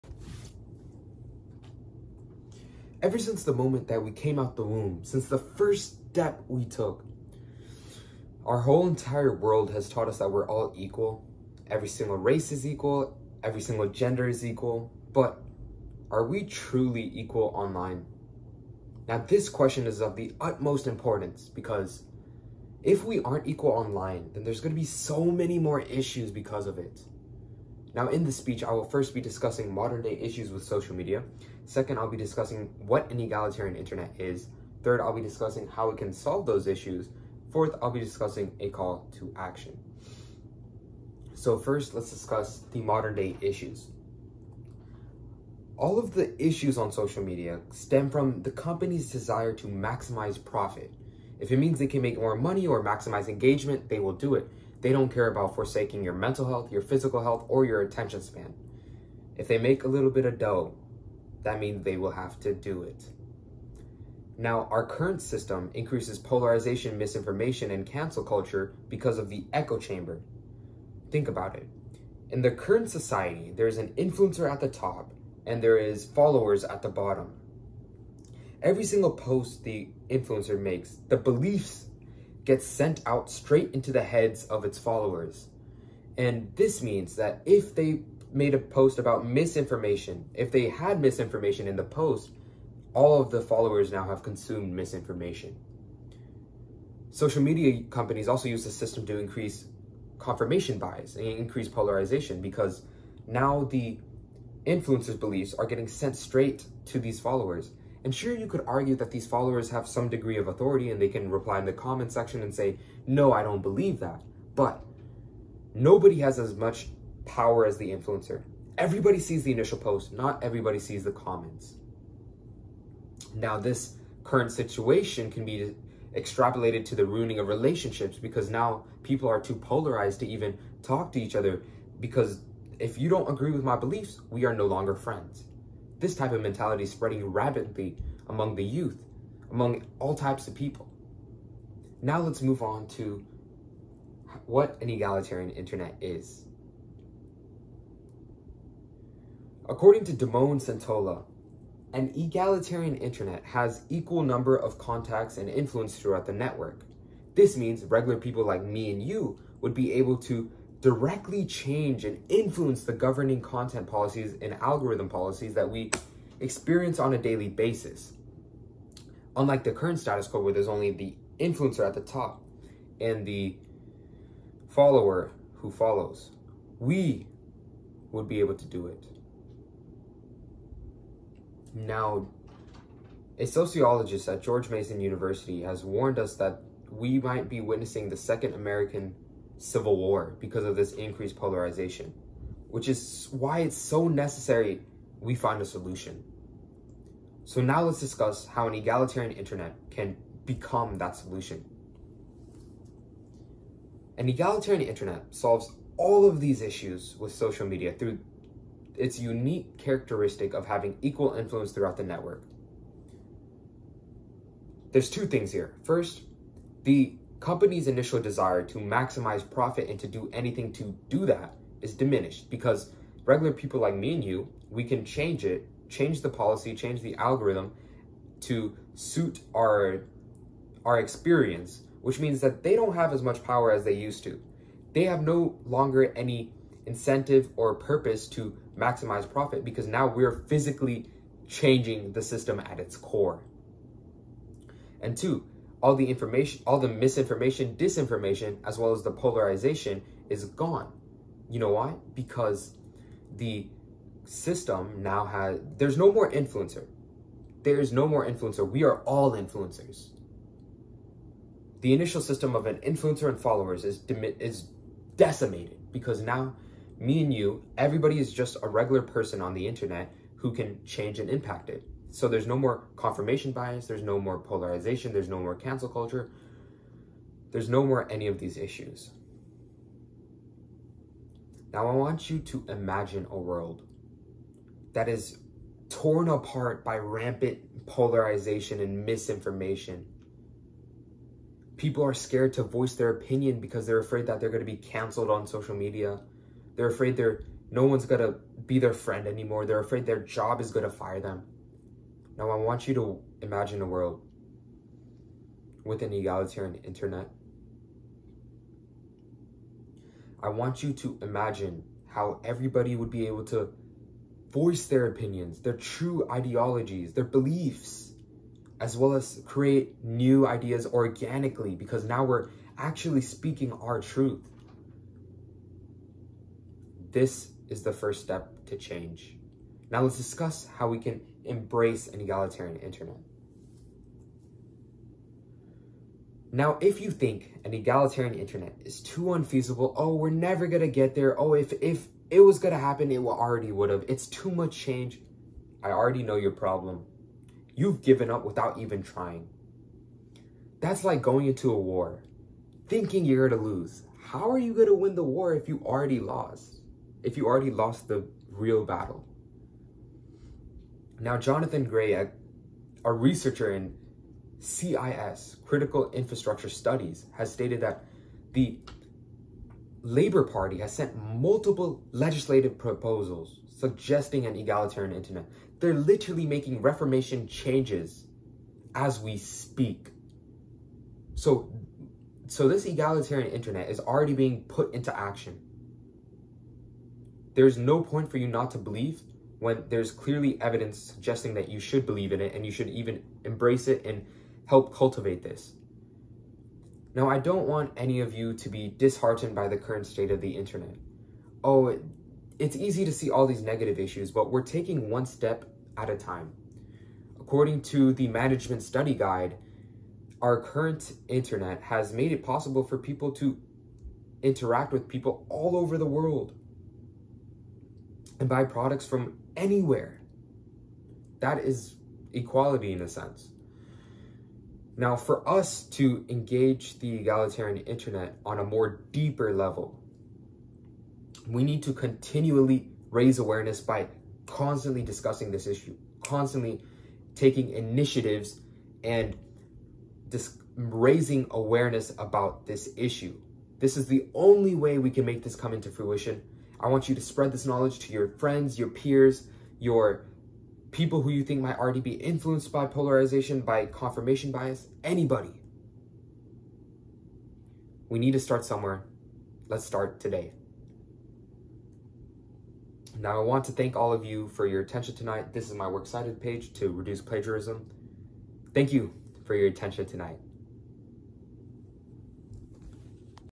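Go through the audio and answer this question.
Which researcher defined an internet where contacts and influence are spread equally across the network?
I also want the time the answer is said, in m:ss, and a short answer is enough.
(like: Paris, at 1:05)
Damon Centola, at 2:30.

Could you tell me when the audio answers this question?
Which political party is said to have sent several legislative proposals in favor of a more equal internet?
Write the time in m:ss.
6:10.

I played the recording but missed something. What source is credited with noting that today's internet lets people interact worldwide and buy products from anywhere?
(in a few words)
Management Study Guide.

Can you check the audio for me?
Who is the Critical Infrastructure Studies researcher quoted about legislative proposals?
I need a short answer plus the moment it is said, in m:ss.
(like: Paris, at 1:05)
Jonathan Gray, at 6:01.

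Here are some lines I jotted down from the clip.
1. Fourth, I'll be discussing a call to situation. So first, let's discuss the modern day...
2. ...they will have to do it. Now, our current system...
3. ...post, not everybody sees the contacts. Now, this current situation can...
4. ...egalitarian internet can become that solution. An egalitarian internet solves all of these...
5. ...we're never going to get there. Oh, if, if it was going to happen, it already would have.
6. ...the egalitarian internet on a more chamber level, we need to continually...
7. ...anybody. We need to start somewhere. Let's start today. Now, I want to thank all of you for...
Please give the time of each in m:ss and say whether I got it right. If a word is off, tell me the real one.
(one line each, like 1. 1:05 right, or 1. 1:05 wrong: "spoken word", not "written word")
1. 0:37 wrong: "action", not "situation"
2. 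1:01 right
3. 1:59 wrong: "comments", not "contacts"
4. 3:18 right
5. 5:40 right
6. 7:06 wrong: "deeper", not "chamber"
7. 7:35 right.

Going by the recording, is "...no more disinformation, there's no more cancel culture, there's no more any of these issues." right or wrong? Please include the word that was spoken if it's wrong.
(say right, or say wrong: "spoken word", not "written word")
wrong: "polarization", not "disinformation".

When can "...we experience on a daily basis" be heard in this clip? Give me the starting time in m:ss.
2:45.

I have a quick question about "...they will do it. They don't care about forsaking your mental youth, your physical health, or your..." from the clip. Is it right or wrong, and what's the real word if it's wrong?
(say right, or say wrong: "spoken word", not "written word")
wrong: "health", not "youth".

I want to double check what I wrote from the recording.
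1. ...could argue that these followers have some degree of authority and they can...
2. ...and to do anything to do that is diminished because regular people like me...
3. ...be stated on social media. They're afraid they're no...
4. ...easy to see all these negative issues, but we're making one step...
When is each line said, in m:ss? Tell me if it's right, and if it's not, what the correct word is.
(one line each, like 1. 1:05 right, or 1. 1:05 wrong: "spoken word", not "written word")
1. 1:48 right
2. 3:39 right
3. 4:54 wrong: "canceled", not "stated"
4. 6:42 wrong: "taking", not "making".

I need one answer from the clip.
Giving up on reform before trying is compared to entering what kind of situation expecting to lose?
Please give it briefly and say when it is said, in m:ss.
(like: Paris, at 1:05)
a war, at 5:51.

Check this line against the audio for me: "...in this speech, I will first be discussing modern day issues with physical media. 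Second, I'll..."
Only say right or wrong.
wrong.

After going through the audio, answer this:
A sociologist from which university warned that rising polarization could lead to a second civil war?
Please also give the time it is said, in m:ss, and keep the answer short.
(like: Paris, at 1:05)
George Mason University, at 3:04.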